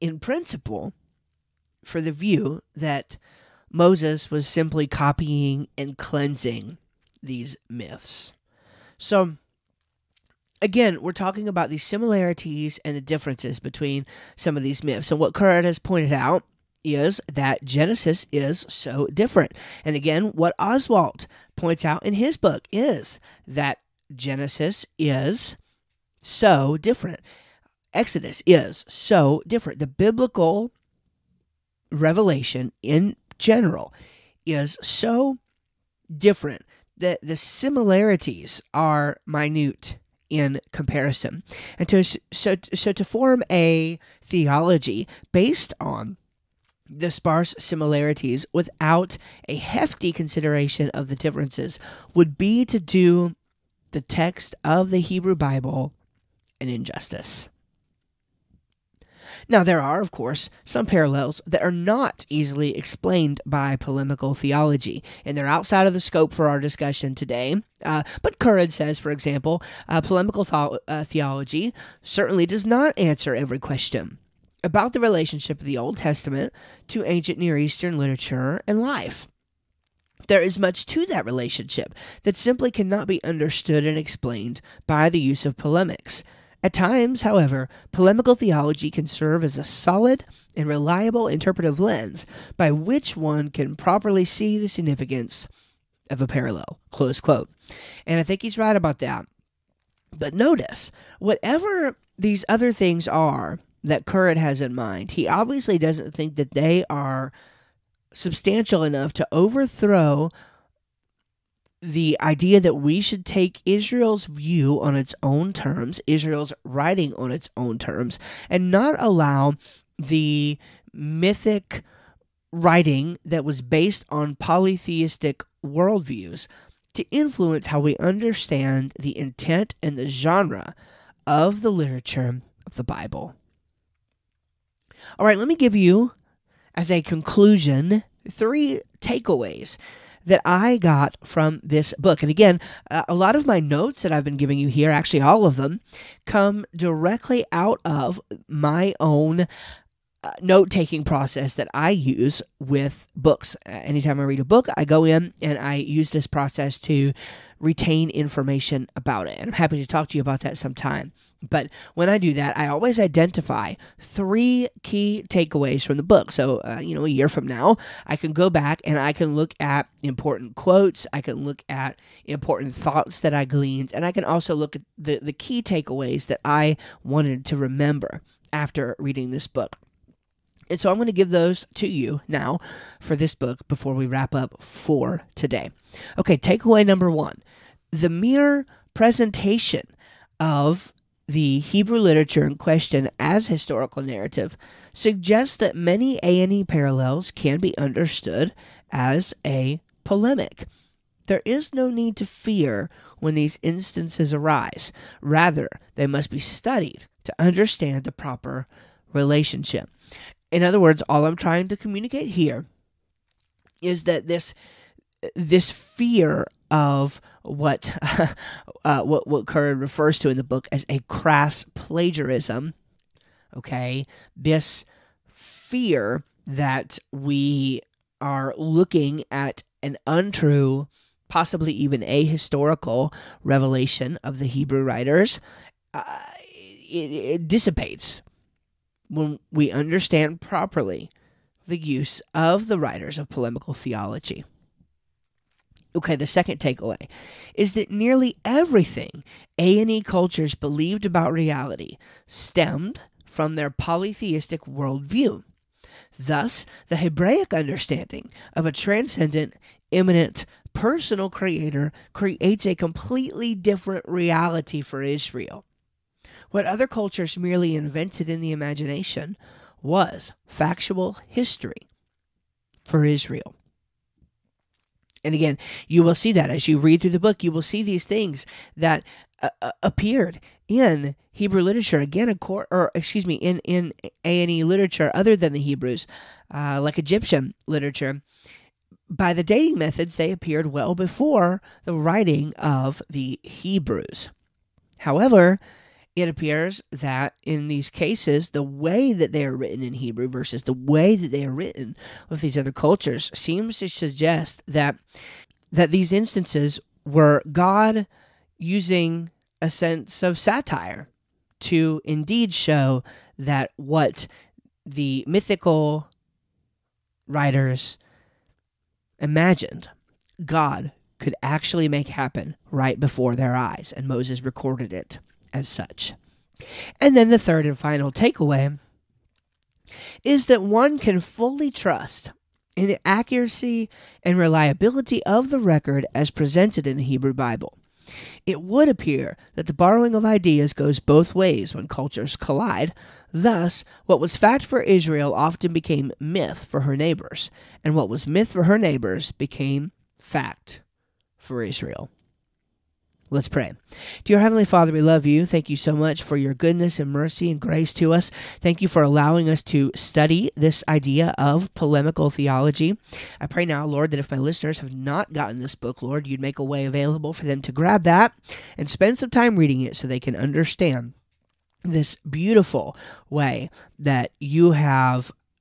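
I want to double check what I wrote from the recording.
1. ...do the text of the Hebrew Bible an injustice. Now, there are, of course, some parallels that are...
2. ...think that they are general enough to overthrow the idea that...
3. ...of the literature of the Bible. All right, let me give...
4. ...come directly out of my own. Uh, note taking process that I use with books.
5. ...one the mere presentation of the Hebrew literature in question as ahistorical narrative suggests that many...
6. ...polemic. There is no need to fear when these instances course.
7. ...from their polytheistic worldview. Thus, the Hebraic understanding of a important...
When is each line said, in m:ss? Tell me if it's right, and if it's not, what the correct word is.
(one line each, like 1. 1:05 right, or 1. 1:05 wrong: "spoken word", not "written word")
1. 0:52 right
2. 1:46 wrong: "substantial", not "general"
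3. 2:11 right
4. 2:26 right
5. 3:07 wrong: "historical", not "ahistorical"
6. 3:20 wrong: "arise", not "course"
7. 4:13 wrong: "transcendent", not "important".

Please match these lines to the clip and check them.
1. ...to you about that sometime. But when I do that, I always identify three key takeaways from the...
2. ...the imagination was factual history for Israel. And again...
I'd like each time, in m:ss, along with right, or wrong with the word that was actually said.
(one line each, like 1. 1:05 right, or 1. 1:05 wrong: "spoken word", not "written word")
1. 2:40 right
2. 4:28 right.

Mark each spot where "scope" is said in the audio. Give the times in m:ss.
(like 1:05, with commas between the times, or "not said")
1:05.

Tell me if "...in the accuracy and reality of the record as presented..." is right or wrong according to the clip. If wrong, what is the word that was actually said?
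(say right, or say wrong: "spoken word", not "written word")
wrong: "reliability", not "reality".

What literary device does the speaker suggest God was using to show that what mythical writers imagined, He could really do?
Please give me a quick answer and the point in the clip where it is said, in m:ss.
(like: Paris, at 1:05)
Satire, at 5:10.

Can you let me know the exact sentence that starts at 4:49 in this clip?
By the dating methods, they appeared well before the writing of the Hebrews.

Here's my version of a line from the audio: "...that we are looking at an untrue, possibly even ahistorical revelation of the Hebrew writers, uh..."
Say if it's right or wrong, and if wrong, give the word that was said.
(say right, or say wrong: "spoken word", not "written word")
right.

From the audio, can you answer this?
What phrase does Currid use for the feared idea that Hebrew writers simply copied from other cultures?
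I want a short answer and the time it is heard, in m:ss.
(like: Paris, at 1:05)
Crass plagiarism, at 3:40.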